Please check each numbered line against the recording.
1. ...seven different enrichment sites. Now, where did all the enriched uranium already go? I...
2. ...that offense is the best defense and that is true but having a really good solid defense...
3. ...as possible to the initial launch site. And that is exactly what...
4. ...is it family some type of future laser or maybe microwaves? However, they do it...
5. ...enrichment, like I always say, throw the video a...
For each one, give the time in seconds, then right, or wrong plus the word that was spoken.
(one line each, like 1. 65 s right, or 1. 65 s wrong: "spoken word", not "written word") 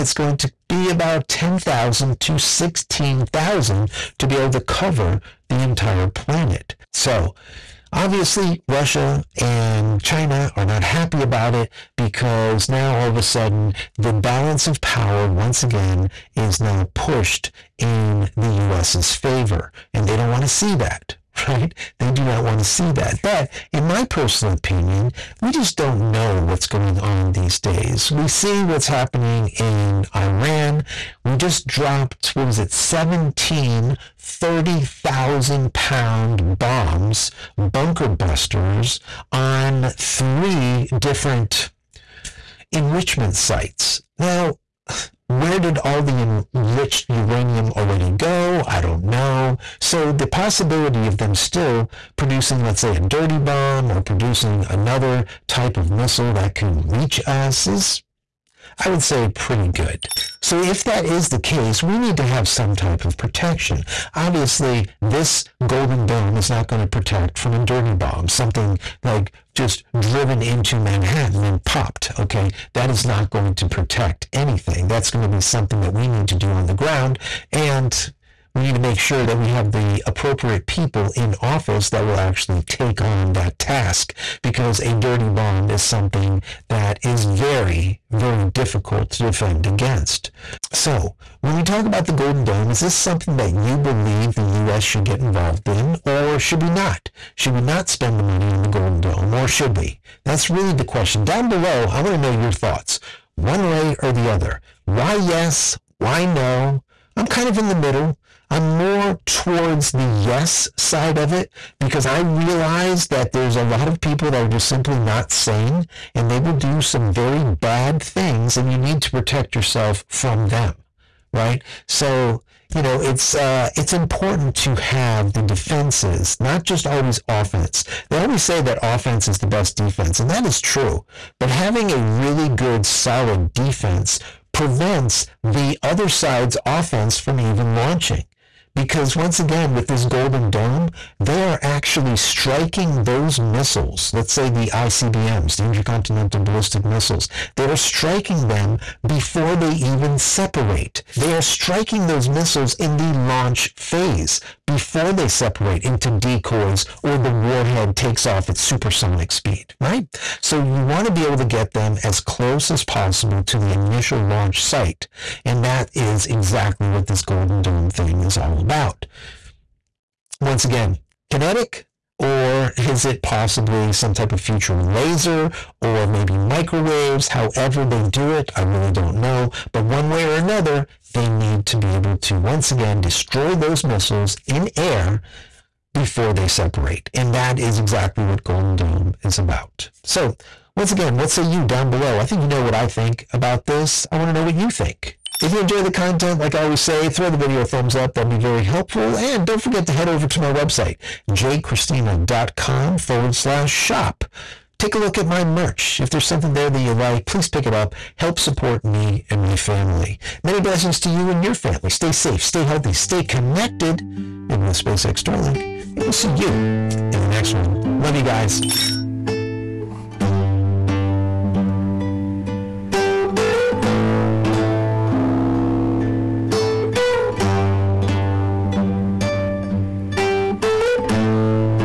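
1. 39 s wrong: "three", not "seven"
2. 128 s right
3. 162 s right
4. 172 s wrong: "possibly", not "family"
5. 195 s wrong: "content", not "enrichment".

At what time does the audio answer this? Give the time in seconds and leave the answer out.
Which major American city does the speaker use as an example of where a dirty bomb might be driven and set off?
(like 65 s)
70 s.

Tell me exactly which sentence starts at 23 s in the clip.
But in my personal opinion, we just don't know what's going on these days.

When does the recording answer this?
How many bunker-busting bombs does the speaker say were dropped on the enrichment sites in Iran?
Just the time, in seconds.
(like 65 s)
32 s.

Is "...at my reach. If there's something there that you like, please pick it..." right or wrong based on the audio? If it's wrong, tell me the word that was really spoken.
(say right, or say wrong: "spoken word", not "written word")
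wrong: "merch", not "reach".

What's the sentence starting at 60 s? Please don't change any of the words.
So if that is the case, we need to have some type of protection.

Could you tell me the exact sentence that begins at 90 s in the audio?
So when we talk about the Golden Dome, is this something that you believe the U.S.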